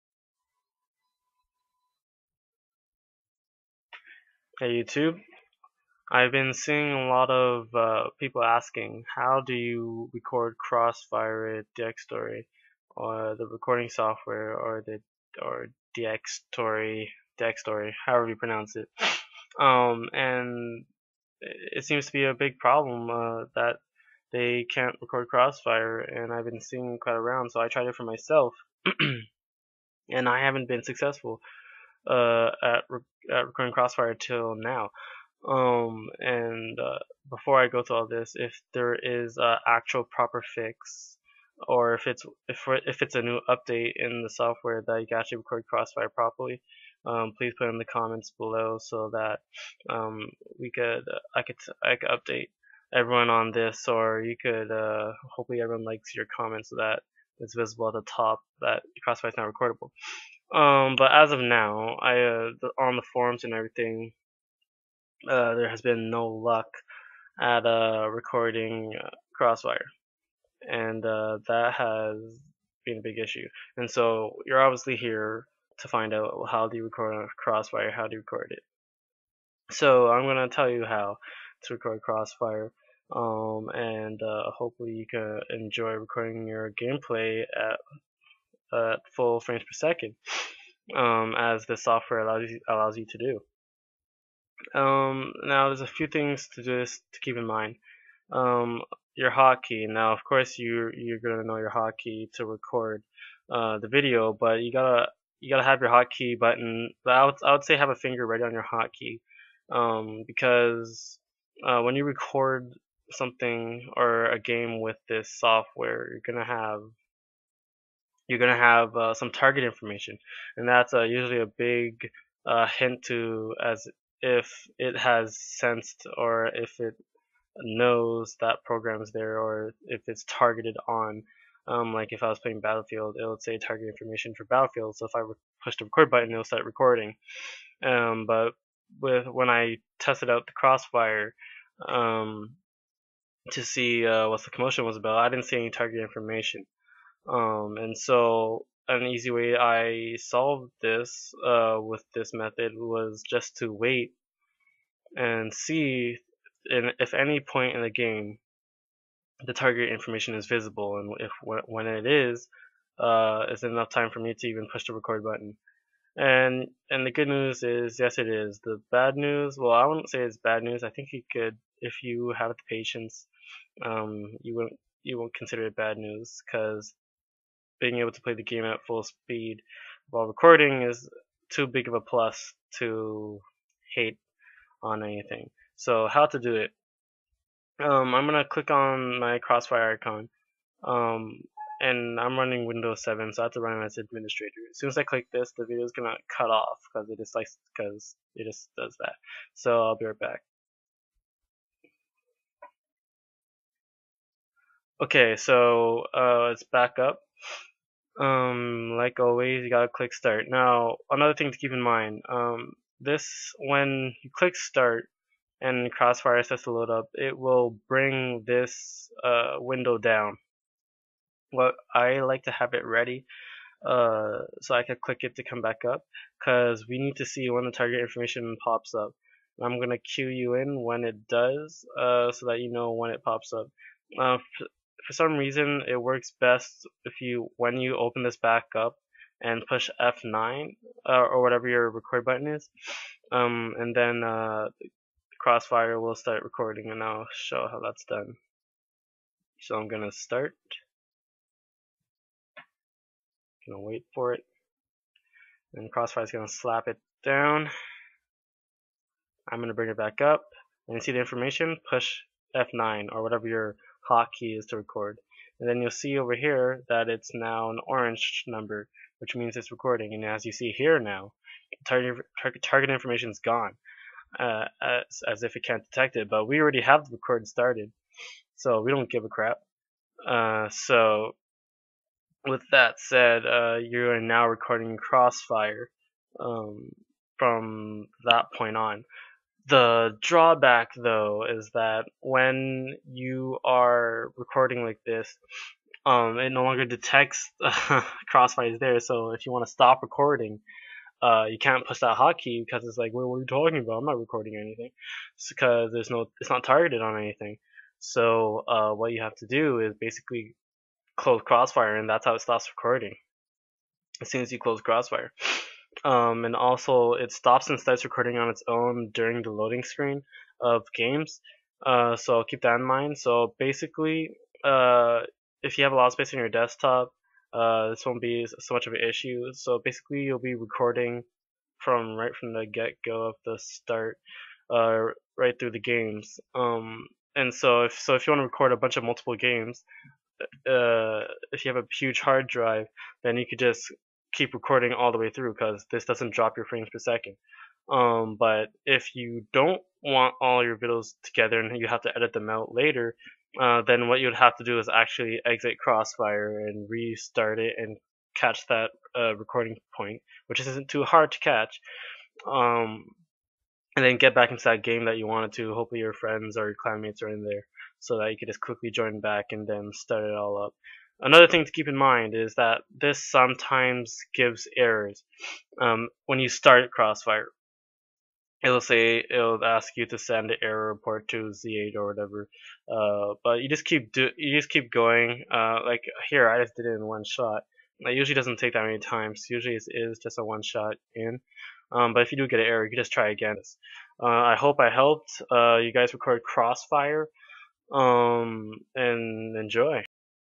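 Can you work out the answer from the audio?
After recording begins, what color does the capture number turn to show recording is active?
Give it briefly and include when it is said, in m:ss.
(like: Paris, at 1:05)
Orange, at 4:27.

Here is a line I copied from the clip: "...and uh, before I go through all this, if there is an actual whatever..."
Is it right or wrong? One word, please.
wrong.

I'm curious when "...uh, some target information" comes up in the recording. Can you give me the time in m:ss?
1:58.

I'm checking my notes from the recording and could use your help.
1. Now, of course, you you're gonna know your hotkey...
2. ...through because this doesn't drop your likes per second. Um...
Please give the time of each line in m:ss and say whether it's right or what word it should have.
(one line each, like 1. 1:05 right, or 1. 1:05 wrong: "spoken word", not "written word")
1. 1:39 right
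2. 5:45 wrong: "frames", not "likes".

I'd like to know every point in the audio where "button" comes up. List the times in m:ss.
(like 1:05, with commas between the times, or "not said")
1:46, 2:16, 2:45, 4:02.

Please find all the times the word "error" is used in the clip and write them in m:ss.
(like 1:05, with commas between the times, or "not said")
6:14, 6:20, 6:32.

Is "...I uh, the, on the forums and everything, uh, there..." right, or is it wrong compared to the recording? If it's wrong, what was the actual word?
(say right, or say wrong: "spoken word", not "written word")
right.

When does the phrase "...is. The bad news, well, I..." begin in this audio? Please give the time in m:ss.
2:48.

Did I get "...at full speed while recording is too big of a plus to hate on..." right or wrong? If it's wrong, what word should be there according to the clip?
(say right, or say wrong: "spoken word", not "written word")
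right.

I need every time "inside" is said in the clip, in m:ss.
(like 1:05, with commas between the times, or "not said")
not said.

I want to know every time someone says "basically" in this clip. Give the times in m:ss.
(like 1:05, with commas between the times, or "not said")
5:09, 5:23, 5:29.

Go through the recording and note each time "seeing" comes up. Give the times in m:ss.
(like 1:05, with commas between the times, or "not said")
0:06, 0:26.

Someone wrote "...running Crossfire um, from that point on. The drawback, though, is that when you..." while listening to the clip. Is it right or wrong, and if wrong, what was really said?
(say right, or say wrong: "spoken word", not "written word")
wrong: "recording", not "running".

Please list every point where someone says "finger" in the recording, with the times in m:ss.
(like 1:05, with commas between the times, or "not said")
1:47.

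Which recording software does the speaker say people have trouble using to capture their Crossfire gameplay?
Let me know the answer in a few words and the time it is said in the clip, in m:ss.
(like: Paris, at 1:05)
Dxtory, at 0:15.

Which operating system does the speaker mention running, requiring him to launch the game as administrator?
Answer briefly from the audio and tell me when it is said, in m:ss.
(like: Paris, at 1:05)
Windows 7, at 3:12.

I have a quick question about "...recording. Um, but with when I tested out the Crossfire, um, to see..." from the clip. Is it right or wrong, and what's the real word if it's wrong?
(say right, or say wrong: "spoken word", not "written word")
right.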